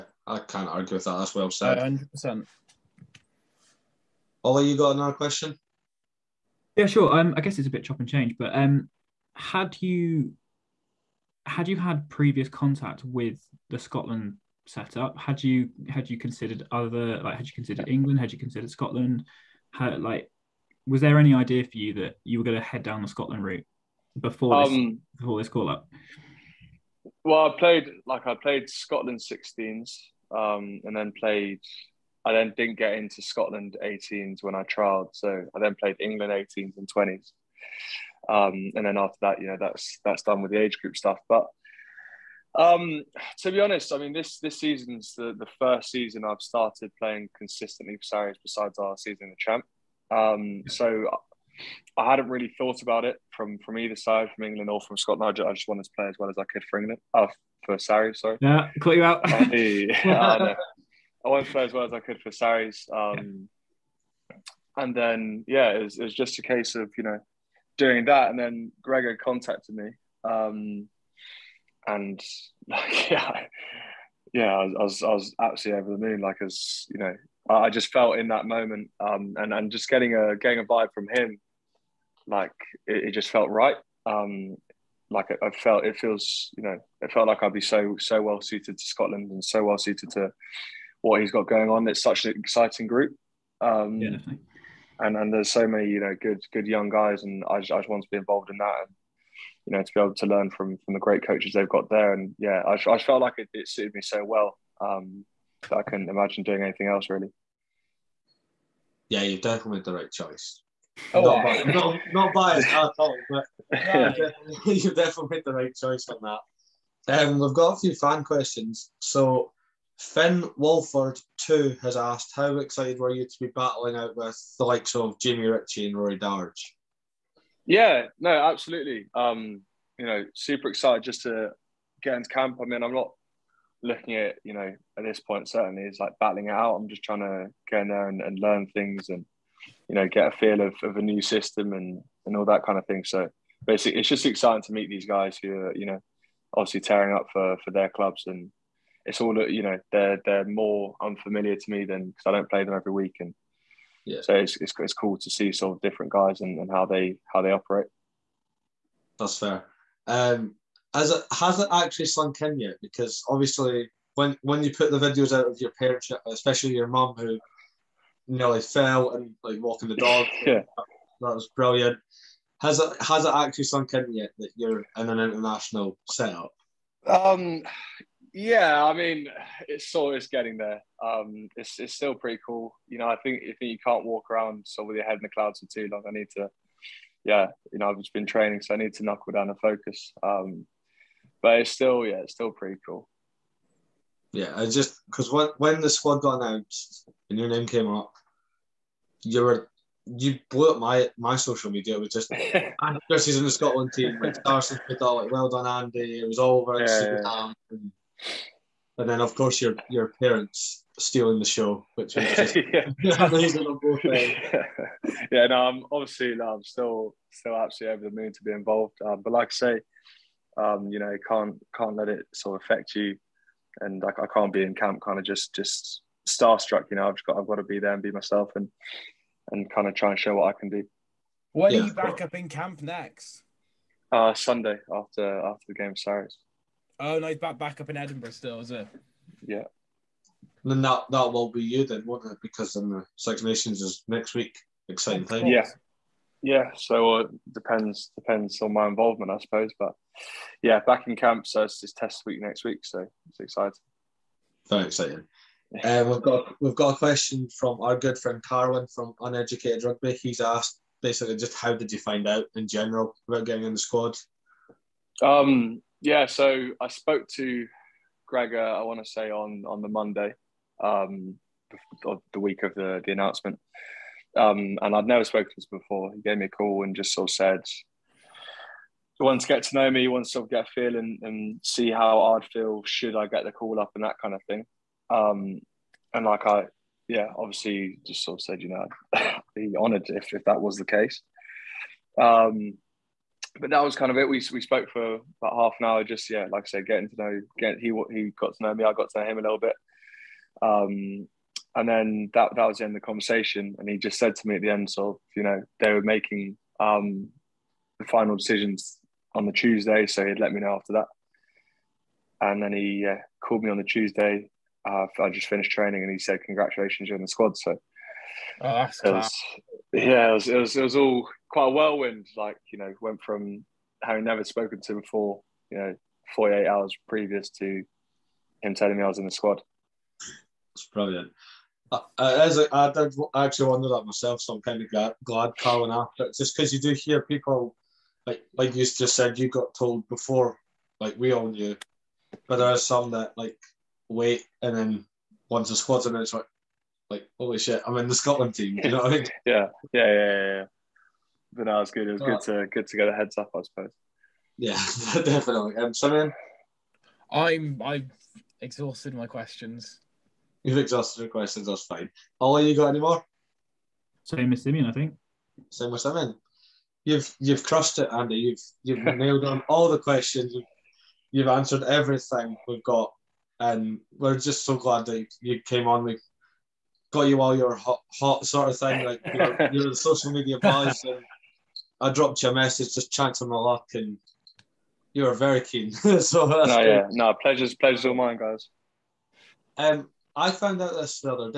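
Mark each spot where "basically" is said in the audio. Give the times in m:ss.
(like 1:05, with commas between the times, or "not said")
2:23, 4:21.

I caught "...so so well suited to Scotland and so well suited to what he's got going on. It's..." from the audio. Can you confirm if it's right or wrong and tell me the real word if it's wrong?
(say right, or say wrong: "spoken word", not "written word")
right.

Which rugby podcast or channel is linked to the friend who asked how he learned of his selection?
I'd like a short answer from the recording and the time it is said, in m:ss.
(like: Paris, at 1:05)
Uneducated Rugby, at 4:19.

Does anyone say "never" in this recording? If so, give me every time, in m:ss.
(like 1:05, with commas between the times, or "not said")
4:35, 5:24.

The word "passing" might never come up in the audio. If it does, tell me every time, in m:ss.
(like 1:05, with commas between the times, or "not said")
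not said.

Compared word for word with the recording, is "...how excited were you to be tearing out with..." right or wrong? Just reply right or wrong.
wrong.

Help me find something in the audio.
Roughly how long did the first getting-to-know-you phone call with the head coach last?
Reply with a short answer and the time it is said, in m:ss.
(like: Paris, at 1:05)
Half an hour, at 4:55.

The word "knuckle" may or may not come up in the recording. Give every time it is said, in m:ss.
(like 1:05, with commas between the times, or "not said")
3:09.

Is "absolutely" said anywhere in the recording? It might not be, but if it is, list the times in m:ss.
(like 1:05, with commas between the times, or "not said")
1:15, 2:08, 3:37.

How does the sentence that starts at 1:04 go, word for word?
And then yeah, it was, it was just a case of you know doing that, and then Gregor contacted me.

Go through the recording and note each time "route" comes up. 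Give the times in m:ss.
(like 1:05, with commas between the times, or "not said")
0:23.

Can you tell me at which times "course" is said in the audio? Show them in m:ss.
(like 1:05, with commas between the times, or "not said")
3:29.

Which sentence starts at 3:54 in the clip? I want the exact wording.
Uh, Sunday after after the game, Cyrus.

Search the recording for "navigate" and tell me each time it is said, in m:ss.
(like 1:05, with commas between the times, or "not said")
not said.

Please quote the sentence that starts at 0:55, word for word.
I just, wanted to play as well as I could for England.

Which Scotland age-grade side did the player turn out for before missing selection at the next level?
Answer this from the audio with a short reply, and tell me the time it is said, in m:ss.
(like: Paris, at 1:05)
Scotland 16s, at 0:28.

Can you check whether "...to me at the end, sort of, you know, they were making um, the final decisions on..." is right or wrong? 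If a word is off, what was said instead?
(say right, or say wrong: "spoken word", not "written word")
right.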